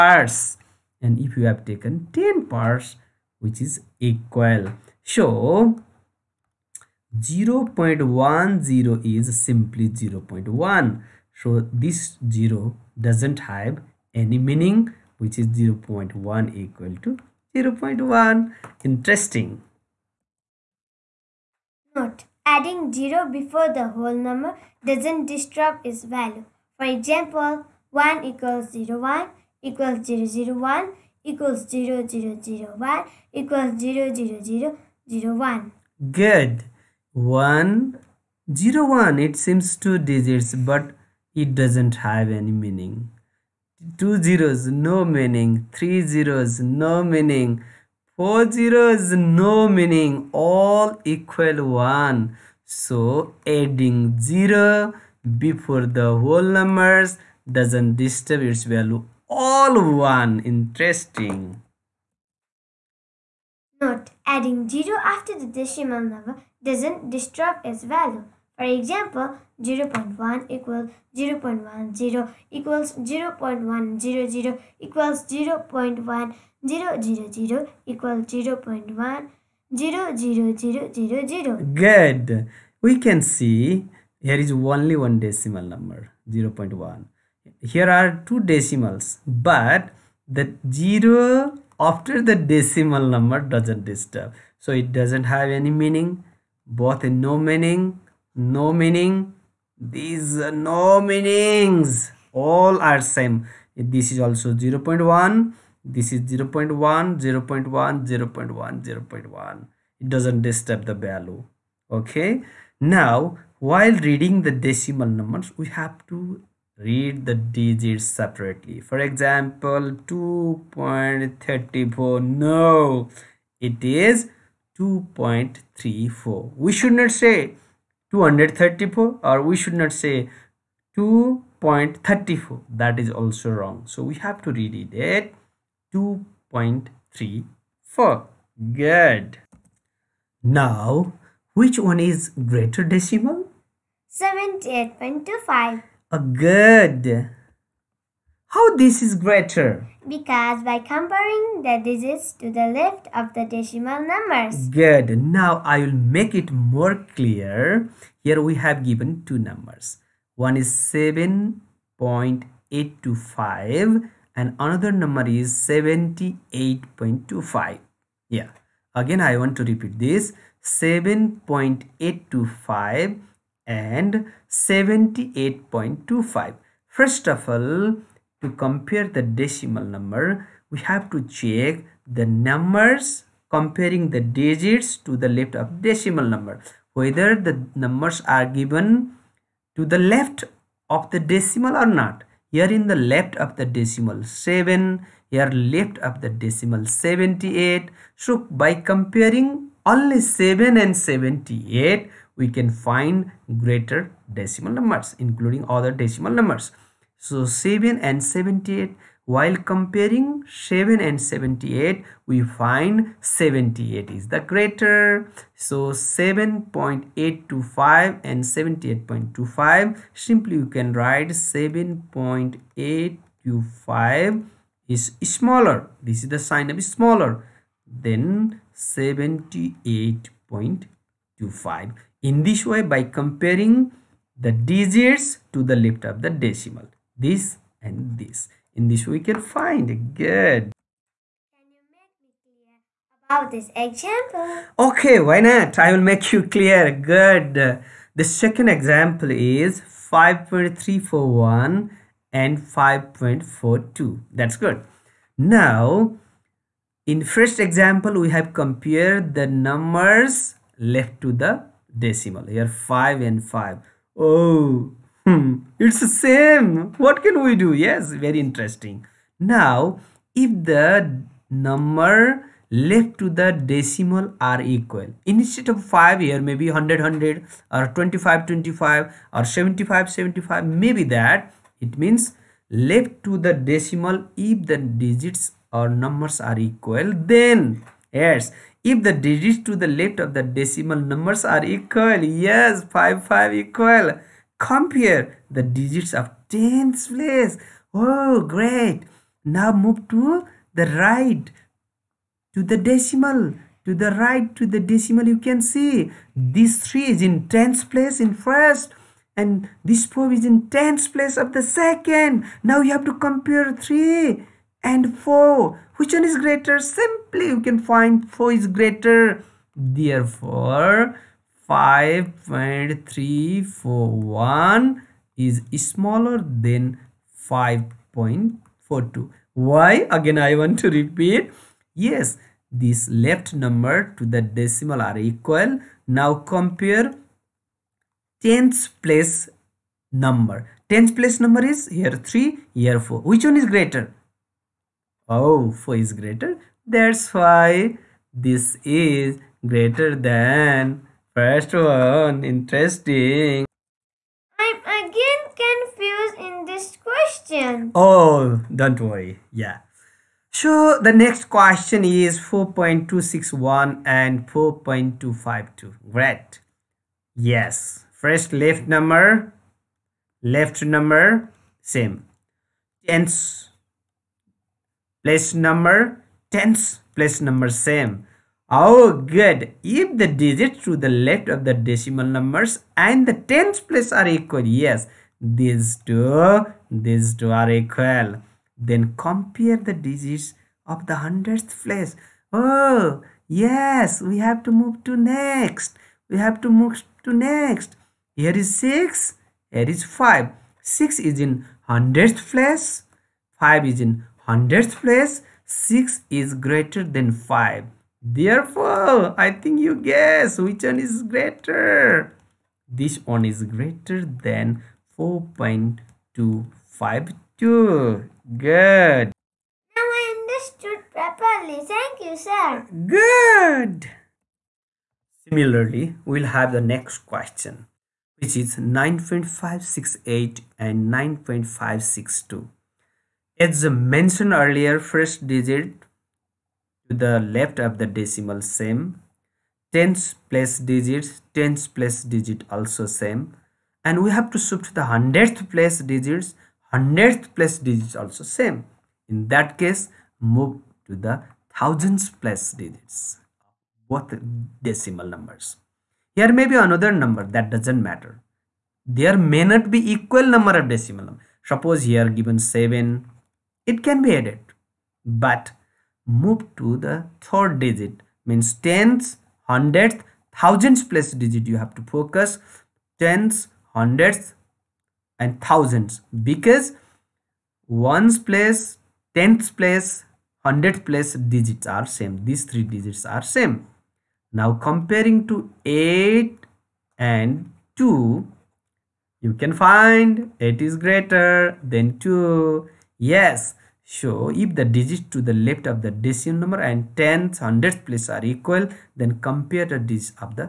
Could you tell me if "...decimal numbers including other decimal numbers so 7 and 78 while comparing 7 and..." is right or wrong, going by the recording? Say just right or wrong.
right.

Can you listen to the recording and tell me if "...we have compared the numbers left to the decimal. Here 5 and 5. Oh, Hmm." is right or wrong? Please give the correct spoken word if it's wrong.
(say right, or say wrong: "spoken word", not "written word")
right.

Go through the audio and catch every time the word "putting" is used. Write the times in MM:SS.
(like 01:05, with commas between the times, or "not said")
not said.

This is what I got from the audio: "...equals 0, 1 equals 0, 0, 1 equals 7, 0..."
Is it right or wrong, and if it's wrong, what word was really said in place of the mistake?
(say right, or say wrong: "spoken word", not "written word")
wrong: "0", not "7".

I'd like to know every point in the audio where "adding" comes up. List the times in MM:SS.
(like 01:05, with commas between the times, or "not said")
00:22, 00:53, 01:04.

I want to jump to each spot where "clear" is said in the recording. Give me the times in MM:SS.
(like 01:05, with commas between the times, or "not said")
02:37, 04:06.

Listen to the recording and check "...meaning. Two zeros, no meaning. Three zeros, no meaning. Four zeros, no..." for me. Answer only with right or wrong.
right.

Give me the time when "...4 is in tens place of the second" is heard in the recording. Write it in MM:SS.
05:10.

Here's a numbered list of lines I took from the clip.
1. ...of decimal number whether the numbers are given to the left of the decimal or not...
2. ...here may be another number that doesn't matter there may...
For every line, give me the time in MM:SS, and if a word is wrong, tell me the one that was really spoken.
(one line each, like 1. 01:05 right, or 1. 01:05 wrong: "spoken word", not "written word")
1. 03:05 right
2. 07:36 right.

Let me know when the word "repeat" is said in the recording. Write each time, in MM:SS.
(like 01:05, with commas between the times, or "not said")
02:49, 05:30.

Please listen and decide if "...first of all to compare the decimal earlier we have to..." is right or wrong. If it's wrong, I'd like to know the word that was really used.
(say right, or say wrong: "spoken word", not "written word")
wrong: "number", not "earlier".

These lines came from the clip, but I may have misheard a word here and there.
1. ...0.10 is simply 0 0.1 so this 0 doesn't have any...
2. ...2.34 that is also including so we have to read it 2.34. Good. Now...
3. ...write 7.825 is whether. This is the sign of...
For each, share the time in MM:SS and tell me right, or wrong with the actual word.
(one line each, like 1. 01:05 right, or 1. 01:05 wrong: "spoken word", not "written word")
1. 00:07 right
2. 02:10 wrong: "wrong", not "including"
3. 03:40 wrong: "smaller", not "whether".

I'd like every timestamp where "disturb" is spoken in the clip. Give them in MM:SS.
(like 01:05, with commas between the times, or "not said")
00:25, 00:57, 01:07, 01:33, 01:50.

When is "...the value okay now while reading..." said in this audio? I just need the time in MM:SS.
01:50.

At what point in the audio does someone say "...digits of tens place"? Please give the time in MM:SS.
04:55.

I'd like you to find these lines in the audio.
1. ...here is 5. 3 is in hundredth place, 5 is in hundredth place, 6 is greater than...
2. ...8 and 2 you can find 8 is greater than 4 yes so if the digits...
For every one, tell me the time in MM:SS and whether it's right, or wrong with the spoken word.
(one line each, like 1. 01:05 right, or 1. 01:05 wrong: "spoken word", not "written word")
1. 06:39 wrong: "6", not "3"
2. 08:05 wrong: "2", not "4".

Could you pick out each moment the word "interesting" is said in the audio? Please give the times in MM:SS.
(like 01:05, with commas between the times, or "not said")
00:18, 01:00, 04:28, 05:52.